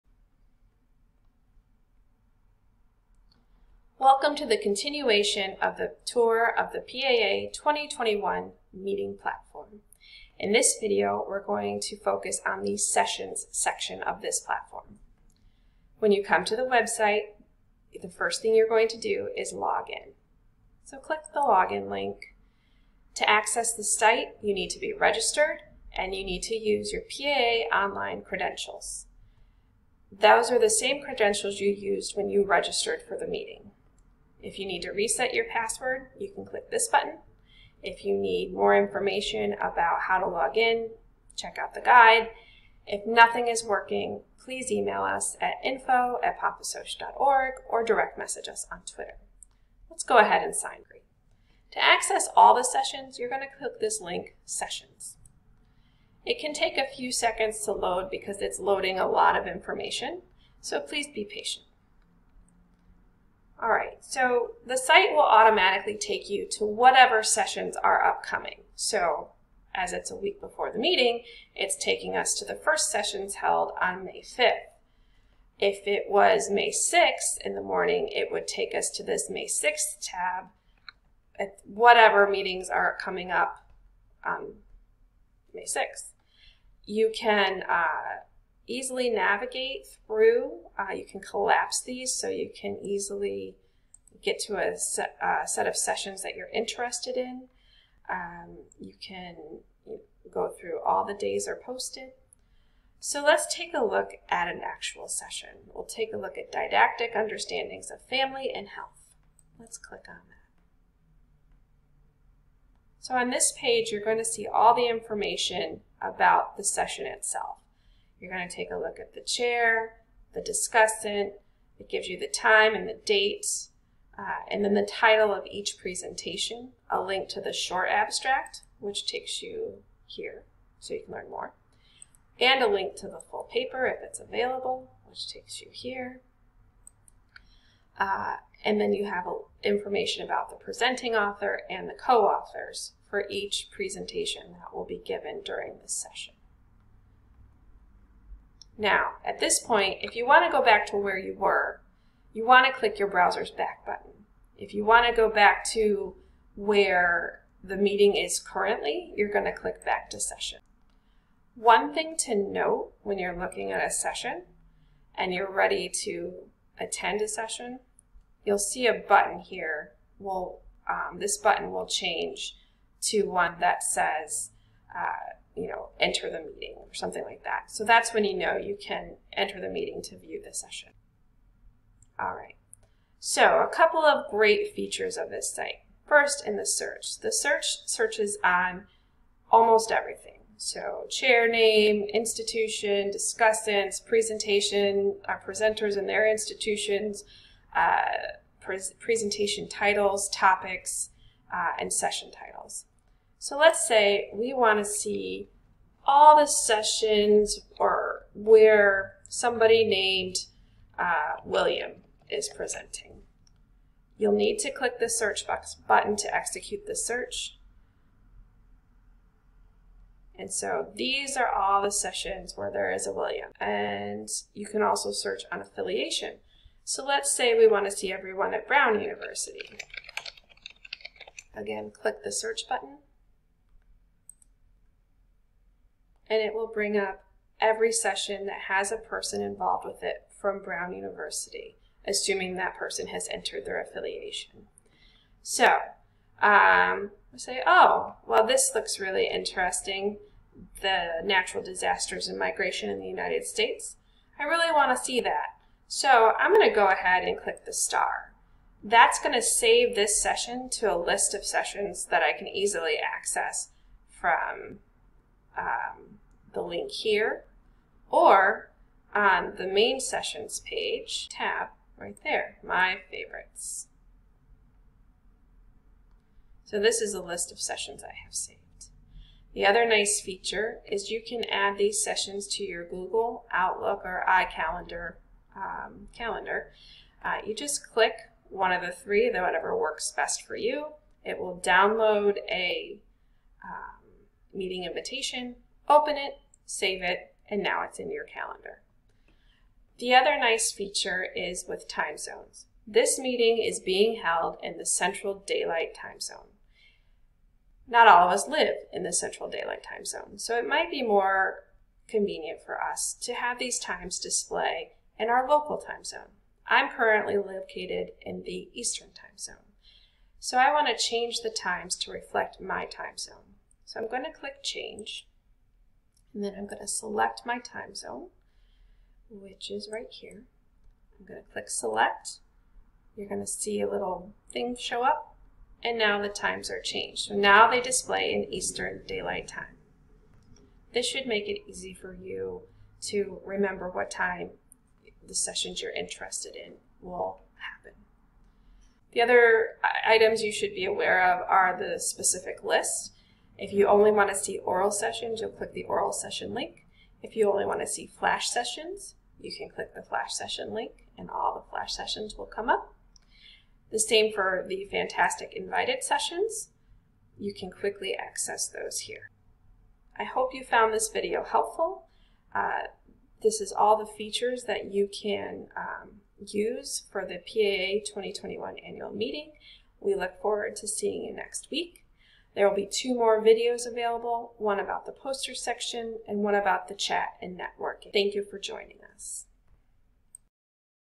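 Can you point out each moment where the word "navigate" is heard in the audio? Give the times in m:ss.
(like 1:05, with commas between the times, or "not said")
1:29.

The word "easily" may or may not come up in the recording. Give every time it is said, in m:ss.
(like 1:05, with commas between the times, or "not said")
1:28, 1:32, 4:22.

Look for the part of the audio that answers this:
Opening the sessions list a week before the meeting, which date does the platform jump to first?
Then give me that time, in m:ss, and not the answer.
1:14.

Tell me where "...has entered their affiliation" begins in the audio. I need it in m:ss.
4:03.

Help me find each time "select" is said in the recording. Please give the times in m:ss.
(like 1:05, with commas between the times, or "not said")
5:26, 5:31.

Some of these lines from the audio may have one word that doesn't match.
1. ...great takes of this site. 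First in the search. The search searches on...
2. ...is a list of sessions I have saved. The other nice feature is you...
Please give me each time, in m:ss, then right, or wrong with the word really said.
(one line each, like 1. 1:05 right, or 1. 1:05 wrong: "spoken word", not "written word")
1. 3:04 wrong: "features", not "takes"
2. 4:37 right.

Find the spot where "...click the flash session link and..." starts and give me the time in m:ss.
5:59.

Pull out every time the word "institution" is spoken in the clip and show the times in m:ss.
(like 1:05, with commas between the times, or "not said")
3:12, 3:16.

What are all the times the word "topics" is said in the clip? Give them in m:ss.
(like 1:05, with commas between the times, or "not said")
3:20.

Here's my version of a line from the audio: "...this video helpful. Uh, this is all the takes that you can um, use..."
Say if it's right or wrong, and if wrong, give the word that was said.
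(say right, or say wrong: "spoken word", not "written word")
wrong: "features", not "takes".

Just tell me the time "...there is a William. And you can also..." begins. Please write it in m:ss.
3:42.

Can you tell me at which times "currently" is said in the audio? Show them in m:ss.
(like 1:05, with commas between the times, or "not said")
2:38, 5:16.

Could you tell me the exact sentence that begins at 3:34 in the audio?
You'll need to click the search box button to execute the search.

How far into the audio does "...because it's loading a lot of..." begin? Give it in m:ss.
0:58.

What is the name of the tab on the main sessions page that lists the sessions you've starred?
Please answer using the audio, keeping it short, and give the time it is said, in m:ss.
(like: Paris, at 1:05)
My favorites, at 4:32.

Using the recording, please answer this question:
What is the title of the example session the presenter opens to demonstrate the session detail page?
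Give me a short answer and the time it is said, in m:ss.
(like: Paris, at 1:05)
Didactic understandings of family and health, at 1:46.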